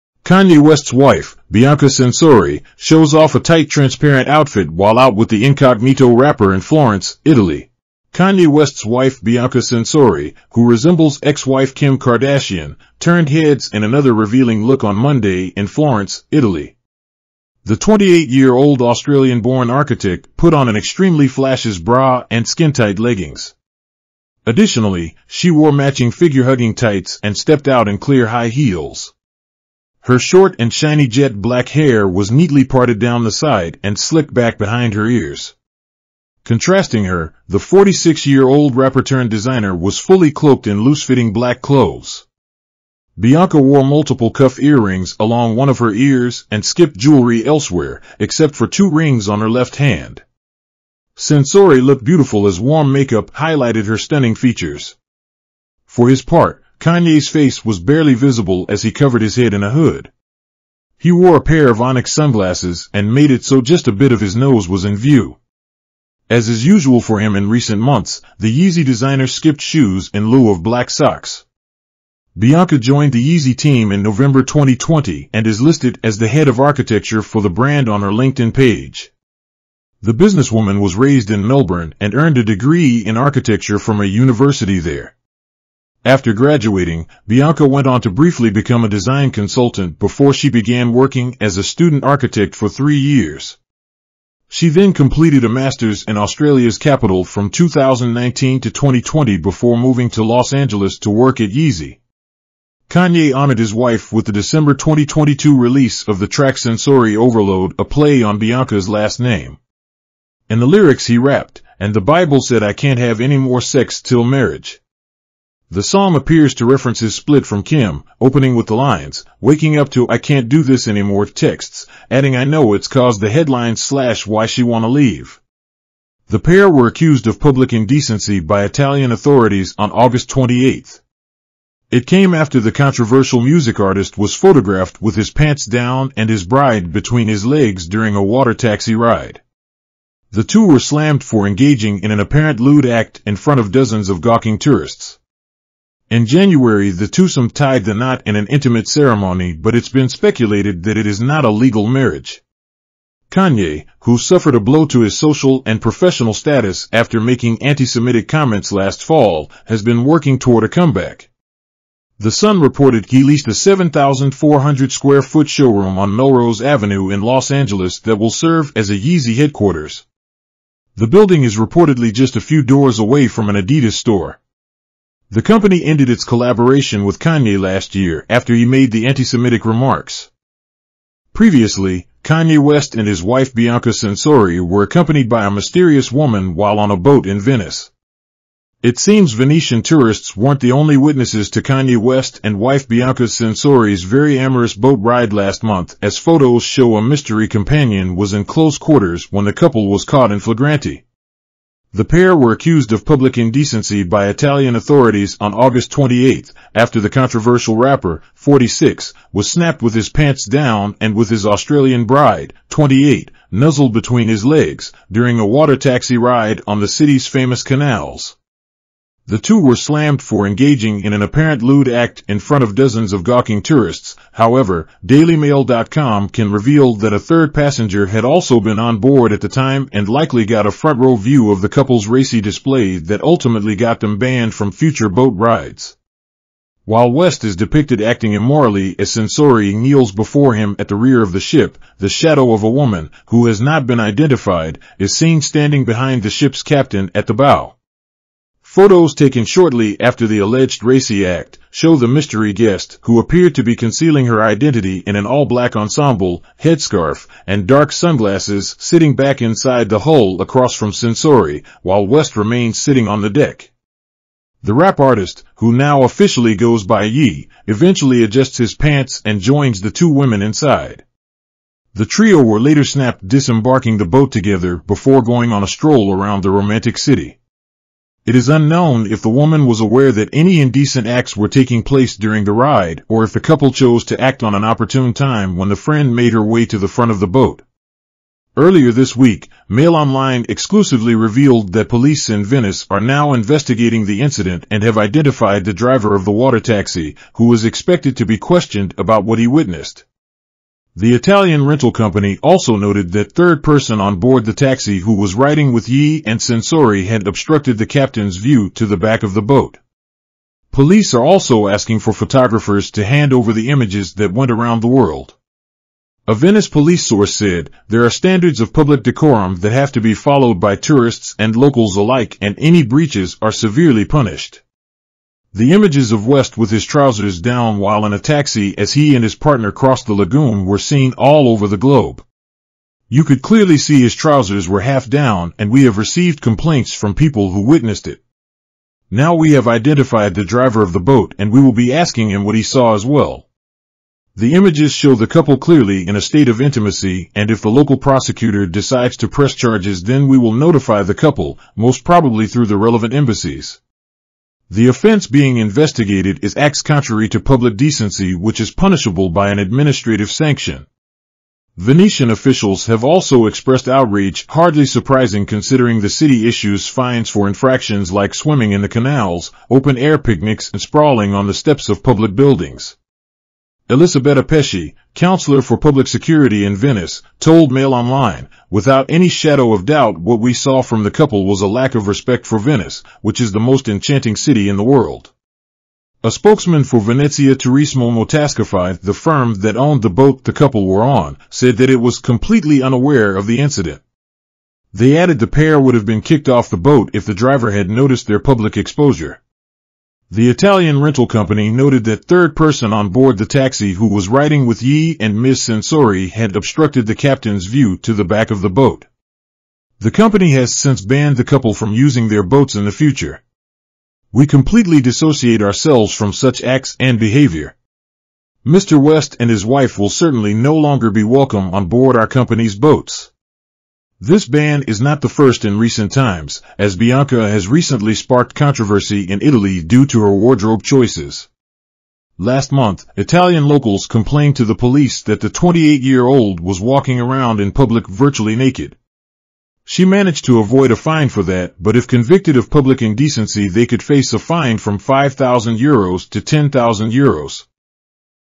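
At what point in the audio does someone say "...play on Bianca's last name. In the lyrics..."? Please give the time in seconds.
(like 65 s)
107 s.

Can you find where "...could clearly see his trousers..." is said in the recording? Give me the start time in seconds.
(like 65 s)
333 s.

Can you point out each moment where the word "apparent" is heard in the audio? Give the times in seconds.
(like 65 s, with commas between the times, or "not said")
142 s, 221 s.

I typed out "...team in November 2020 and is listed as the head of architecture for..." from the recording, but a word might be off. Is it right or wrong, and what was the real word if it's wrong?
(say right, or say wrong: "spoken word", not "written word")
right.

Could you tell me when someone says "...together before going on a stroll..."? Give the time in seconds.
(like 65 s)
274 s.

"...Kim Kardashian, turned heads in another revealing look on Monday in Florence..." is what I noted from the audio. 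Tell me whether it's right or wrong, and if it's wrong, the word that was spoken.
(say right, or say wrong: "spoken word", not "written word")
right.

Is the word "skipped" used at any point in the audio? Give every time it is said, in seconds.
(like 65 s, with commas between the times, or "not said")
46 s, 69 s.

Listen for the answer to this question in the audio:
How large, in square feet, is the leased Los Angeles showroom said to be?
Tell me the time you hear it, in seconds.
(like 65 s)
163 s.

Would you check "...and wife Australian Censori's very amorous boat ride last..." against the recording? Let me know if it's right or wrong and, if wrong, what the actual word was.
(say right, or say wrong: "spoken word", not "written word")
wrong: "Bianca", not "Australian".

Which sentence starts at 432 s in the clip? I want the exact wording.
Last month, Italian locals complained to the police that the 28-year-old was walking around in public virtually naked.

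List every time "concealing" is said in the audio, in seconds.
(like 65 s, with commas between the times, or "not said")
253 s.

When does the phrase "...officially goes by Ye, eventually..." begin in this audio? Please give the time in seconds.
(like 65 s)
266 s.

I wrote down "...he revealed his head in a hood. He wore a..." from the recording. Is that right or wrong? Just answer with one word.
wrong.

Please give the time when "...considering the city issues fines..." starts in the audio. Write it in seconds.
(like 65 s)
365 s.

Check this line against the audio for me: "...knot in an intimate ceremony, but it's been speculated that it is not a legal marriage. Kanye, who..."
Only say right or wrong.
right.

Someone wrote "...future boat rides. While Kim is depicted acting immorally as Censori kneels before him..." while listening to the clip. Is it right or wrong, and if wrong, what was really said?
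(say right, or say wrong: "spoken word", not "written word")
wrong: "West", not "Kim".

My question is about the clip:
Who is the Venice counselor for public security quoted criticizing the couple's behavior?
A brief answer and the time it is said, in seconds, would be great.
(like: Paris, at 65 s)
Elisabetta Pesci, at 373 s.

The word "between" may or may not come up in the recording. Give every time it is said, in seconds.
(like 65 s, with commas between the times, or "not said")
136 s, 213 s.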